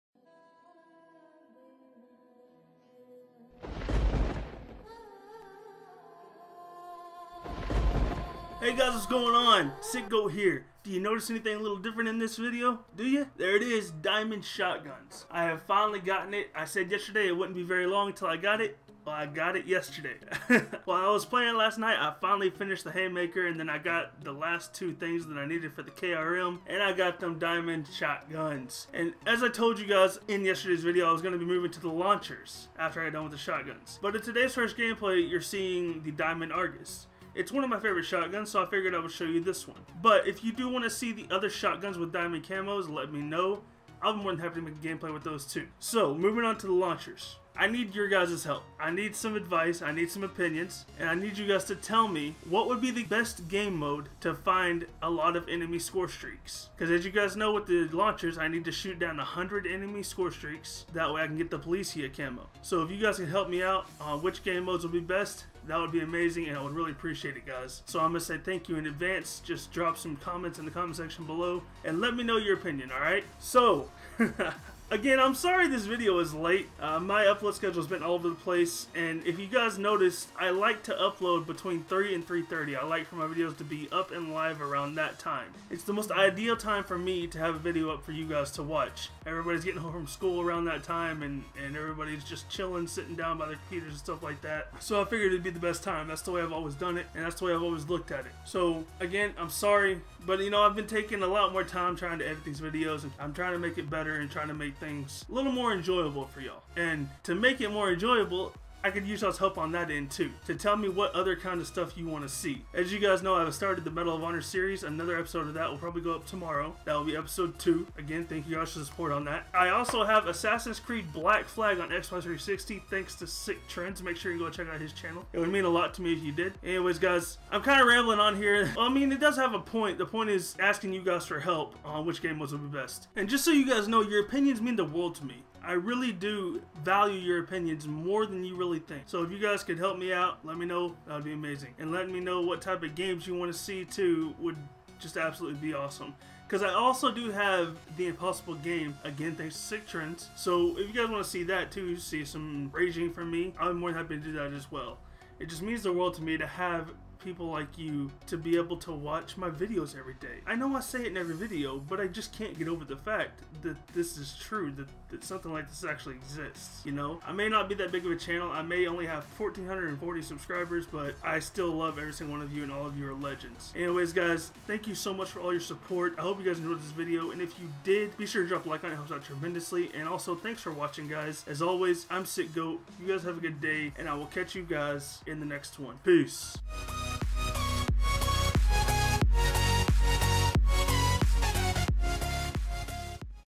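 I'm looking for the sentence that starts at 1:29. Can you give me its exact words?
Everybody's getting home from school around that time, and, and everybody's just chilling, sitting down by their computers and stuff like that.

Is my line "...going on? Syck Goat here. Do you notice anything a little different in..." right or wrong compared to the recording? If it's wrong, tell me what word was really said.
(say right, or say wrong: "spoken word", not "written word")
right.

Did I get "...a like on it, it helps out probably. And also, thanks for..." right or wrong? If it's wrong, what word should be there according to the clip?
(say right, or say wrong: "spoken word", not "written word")
wrong: "tremendously", not "probably".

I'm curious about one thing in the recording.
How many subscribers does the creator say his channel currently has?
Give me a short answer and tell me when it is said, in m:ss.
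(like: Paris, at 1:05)
1,440, at 2:49.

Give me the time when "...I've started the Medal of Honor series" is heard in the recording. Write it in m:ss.
1:53.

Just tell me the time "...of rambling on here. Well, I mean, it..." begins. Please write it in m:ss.
2:07.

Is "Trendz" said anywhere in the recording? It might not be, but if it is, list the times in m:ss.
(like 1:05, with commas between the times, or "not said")
2:03, 2:29.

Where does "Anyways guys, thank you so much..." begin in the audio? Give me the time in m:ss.
2:53.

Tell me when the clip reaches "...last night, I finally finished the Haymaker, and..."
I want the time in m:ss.
0:21.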